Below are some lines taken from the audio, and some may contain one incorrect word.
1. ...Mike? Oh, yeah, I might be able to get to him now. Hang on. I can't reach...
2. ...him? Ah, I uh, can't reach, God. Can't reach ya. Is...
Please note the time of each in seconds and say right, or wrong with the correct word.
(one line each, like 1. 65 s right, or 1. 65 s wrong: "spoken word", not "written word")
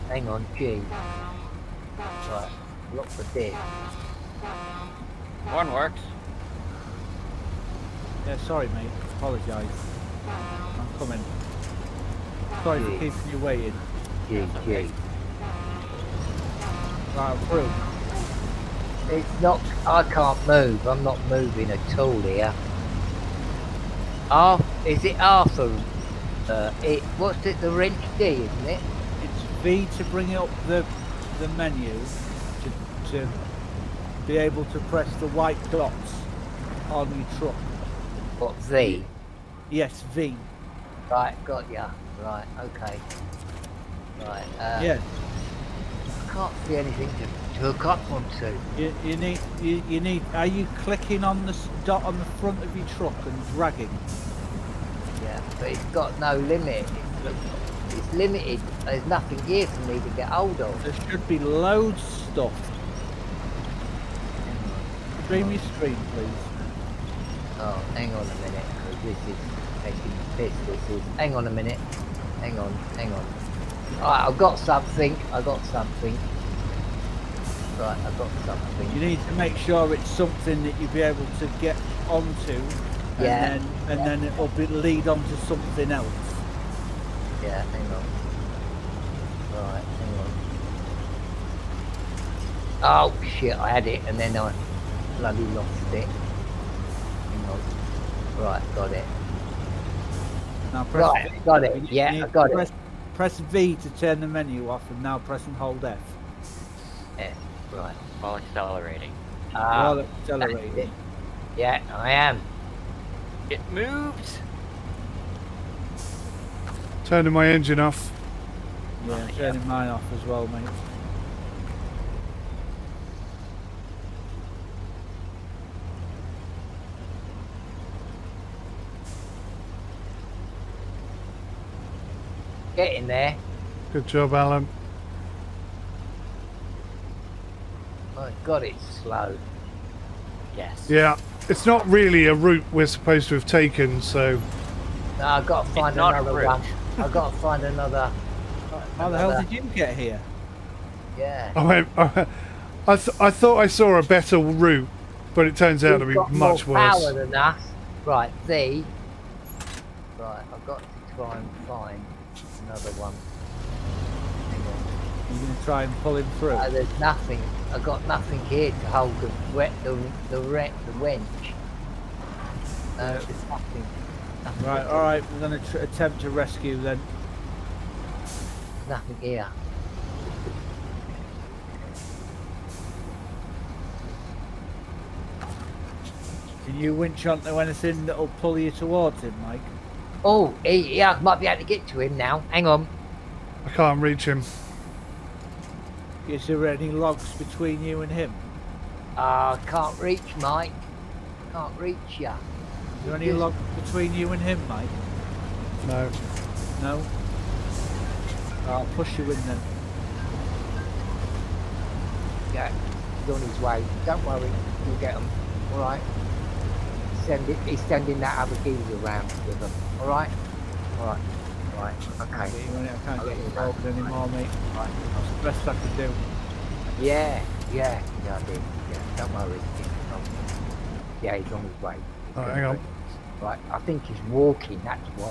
1. 189 s right
2. 198 s wrong: "Mike", not "God".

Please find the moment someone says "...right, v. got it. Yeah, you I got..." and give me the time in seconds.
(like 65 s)
101 s.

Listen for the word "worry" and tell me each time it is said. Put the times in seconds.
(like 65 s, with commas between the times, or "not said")
214 s, 229 s.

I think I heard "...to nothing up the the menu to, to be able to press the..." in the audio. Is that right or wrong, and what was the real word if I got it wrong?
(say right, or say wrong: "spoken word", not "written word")
wrong: "bring", not "nothing".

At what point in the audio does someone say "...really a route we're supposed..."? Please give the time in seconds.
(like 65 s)
141 s.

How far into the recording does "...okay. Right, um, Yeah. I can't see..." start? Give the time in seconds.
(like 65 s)
42 s.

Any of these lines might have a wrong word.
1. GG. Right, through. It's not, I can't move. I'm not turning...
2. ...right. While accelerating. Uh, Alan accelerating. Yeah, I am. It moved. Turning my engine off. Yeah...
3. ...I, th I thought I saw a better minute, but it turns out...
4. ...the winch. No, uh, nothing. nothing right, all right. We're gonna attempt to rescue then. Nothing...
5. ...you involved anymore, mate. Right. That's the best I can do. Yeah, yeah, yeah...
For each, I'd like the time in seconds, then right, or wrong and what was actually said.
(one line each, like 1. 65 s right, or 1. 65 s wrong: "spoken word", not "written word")
1. 14 s wrong: "moving", not "turning"
2. 107 s wrong: "While", not "Alan"
3. 152 s wrong: "route", not "minute"
4. 170 s right
5. 223 s right.